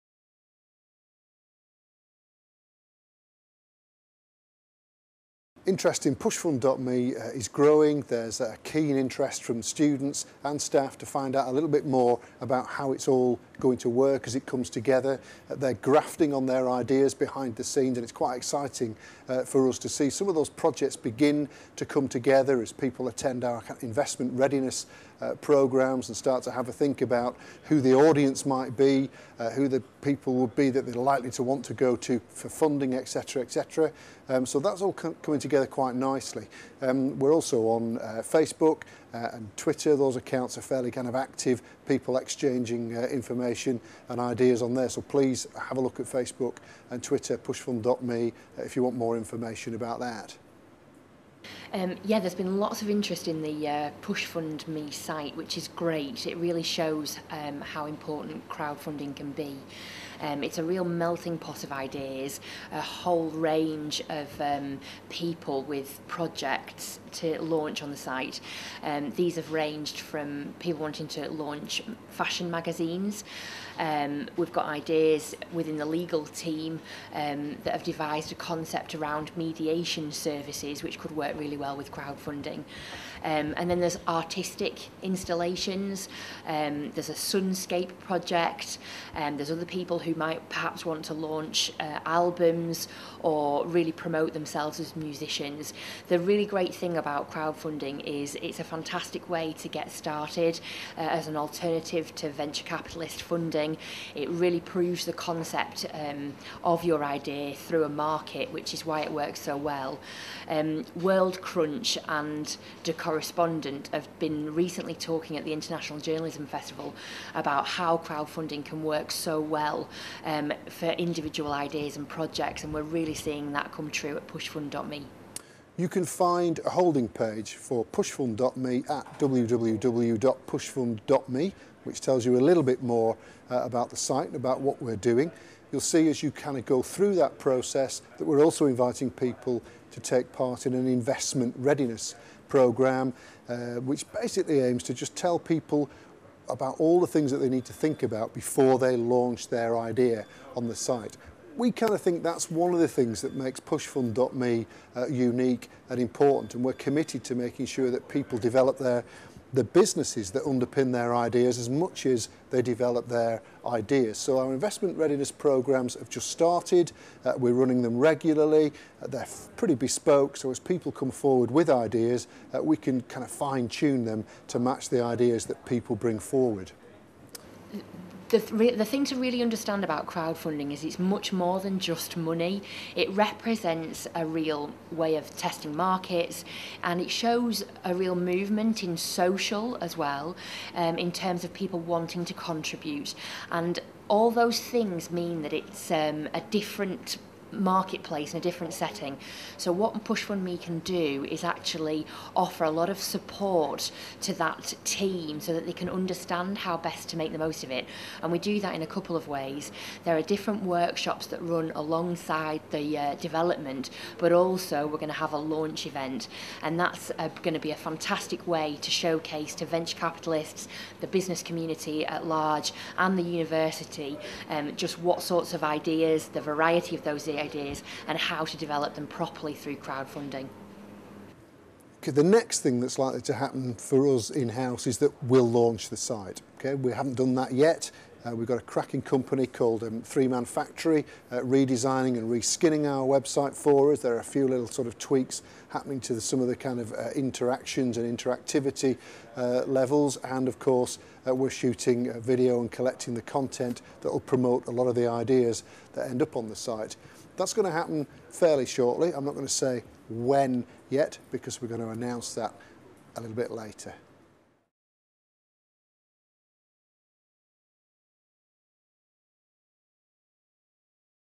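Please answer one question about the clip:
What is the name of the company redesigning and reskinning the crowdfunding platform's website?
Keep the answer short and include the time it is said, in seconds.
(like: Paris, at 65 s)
Three Man Factory, at 240 s.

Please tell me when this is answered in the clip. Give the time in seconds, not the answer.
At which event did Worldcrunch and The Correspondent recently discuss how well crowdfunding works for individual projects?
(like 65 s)
115 s.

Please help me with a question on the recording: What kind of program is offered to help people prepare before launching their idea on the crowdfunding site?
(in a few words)
Investment readiness program.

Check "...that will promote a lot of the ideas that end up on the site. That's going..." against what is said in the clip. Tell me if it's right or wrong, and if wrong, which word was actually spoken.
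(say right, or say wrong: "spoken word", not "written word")
right.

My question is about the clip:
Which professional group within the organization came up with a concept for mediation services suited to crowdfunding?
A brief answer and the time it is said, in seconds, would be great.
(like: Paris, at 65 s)
The legal team, at 75 s.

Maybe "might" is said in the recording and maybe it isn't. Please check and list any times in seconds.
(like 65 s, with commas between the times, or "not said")
28 s, 90 s.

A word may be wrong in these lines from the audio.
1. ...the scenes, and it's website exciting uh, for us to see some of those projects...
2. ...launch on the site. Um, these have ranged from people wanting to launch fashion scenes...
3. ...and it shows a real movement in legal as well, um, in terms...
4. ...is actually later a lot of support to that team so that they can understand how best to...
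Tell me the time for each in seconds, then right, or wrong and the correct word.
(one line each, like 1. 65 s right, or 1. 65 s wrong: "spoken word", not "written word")
1. 17 s wrong: "quite", not "website"
2. 67 s wrong: "magazines", not "scenes"
3. 186 s wrong: "social", not "legal"
4. 201 s wrong: "offer", not "later".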